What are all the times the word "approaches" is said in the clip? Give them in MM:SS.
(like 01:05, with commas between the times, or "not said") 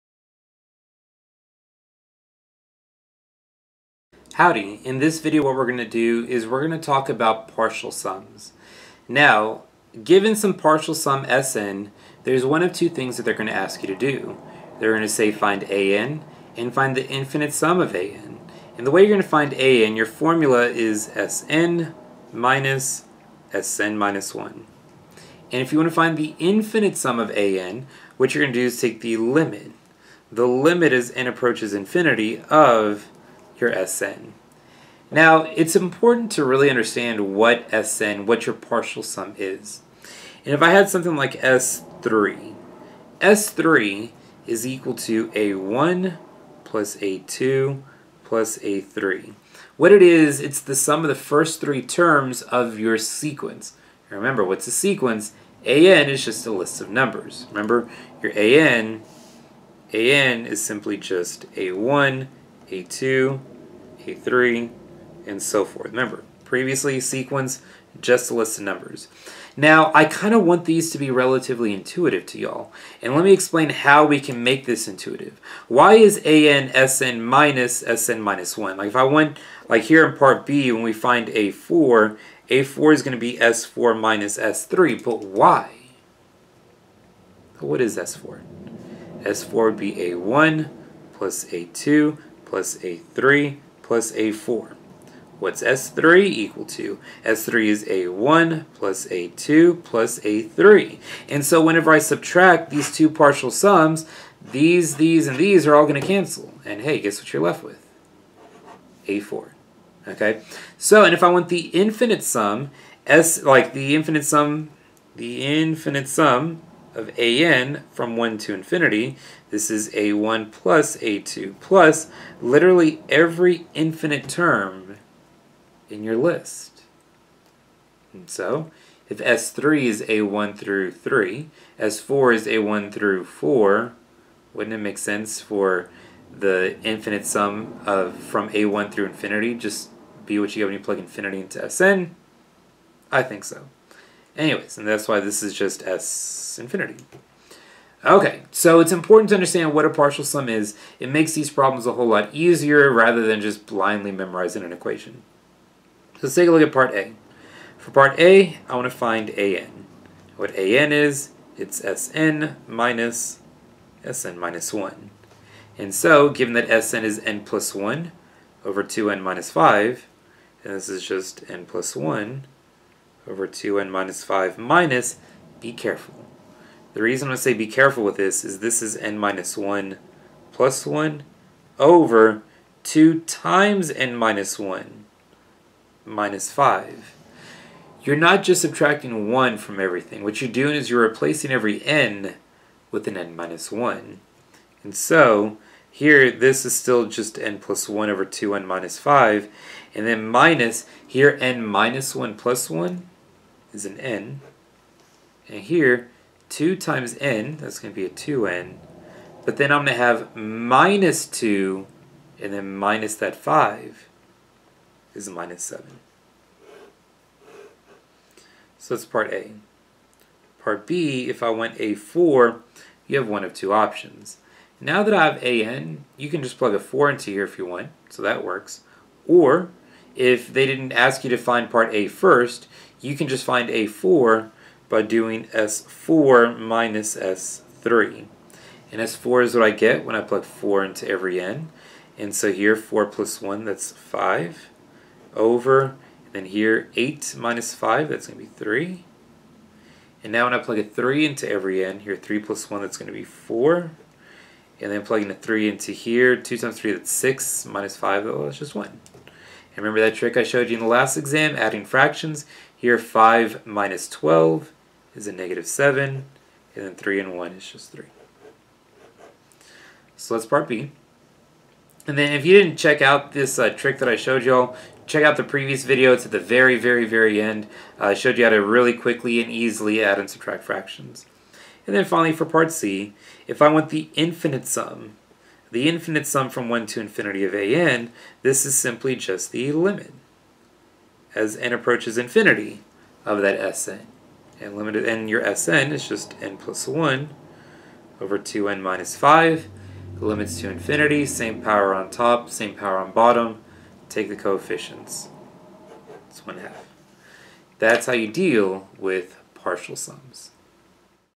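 00:31, 04:51.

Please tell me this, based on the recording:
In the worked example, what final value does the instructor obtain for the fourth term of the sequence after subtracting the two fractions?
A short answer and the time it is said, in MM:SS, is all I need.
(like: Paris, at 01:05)
-7/3, at 04:25.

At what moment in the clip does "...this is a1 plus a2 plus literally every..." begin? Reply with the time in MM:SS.
01:59.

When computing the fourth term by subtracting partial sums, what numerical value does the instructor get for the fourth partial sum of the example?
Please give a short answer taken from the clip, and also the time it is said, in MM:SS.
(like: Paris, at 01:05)
5/3, at 04:03.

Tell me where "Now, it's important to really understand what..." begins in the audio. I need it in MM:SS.
00:35.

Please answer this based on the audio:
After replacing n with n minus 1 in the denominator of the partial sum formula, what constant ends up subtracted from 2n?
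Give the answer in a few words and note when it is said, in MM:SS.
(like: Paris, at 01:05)
7, at 03:35.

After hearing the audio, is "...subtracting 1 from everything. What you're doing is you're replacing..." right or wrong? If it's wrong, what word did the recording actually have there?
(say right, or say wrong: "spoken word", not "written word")
right.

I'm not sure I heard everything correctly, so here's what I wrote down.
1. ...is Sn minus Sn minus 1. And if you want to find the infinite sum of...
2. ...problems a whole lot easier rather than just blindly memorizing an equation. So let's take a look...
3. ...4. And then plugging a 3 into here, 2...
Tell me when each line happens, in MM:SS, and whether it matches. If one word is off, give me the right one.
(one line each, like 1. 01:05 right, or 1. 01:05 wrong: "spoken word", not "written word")
1. 00:20 right
2. 02:31 right
3. 04:13 right.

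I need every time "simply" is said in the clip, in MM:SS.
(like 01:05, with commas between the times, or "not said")
01:00, 04:48.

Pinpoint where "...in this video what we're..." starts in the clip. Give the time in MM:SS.
00:04.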